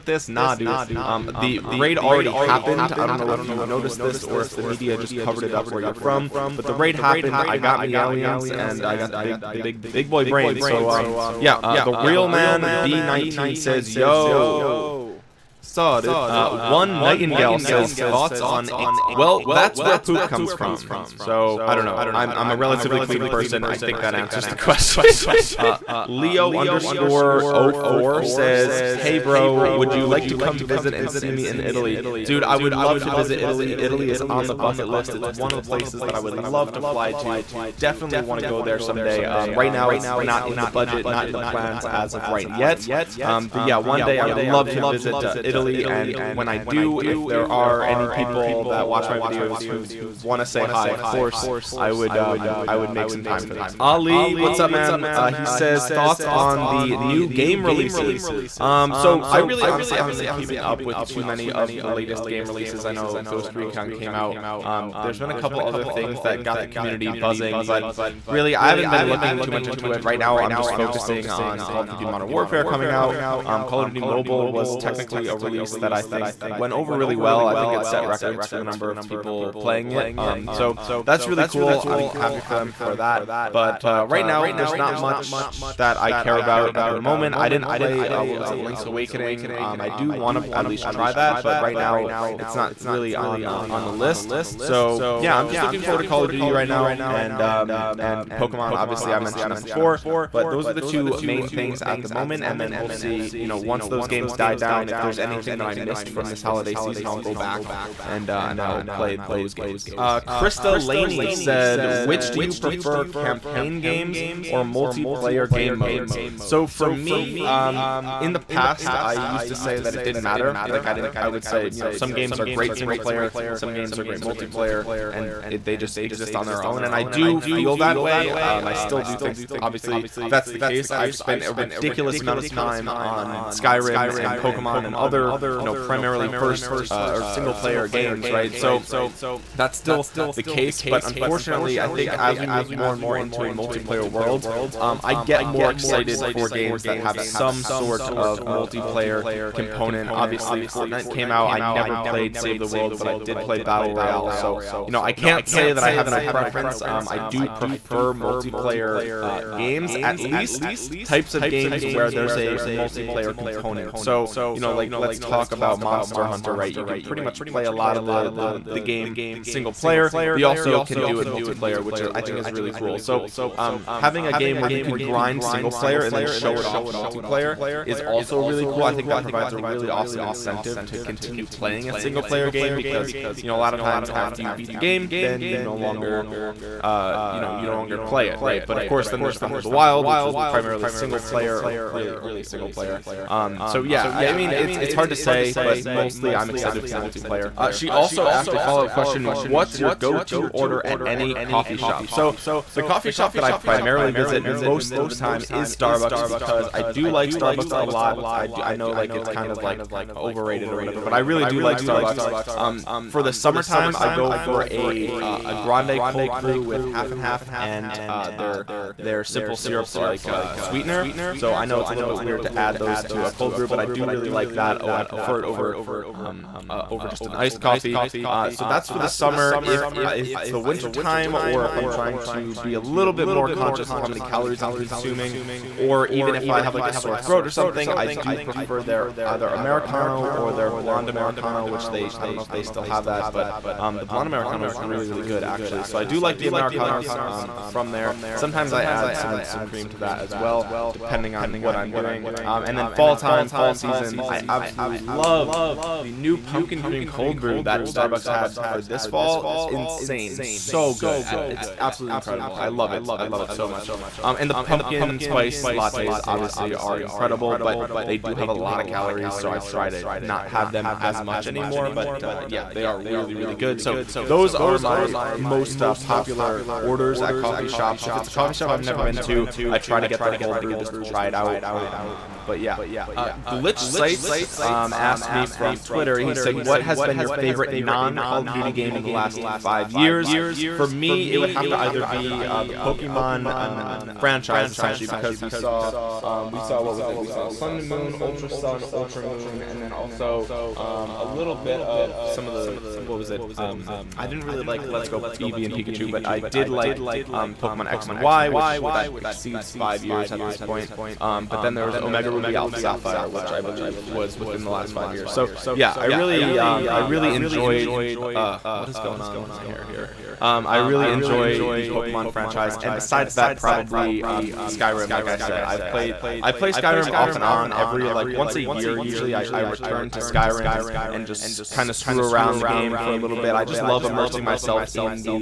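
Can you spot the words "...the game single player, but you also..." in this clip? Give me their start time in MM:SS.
02:48.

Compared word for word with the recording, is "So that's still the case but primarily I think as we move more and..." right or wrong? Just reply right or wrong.
wrong.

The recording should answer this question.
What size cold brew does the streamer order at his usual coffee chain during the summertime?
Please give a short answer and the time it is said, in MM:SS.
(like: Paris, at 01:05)
Grande, at 03:35.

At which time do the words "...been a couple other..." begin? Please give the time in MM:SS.
01:05.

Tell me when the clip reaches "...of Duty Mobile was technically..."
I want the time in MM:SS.
01:13.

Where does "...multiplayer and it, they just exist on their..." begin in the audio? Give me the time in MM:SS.
02:04.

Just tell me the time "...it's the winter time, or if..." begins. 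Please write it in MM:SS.
03:50.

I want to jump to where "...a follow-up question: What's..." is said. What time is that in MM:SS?
03:18.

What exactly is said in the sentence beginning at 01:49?
Uh, Krista Laney said, which do you prefer, campaign games or multiplayer game modes?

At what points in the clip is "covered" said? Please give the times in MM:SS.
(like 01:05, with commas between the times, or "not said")
00:05.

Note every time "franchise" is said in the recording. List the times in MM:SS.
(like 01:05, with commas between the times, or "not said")
04:54, 05:22.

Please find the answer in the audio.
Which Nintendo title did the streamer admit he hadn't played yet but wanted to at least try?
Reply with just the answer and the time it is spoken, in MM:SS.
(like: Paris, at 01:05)
Link's Awakening, at 01:28.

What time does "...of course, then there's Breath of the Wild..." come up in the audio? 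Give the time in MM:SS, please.
03:08.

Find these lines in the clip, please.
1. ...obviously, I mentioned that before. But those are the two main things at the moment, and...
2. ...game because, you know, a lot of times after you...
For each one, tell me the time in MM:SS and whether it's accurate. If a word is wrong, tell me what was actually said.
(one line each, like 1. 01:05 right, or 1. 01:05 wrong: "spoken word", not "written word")
1. 01:38 right
2. 03:02 right.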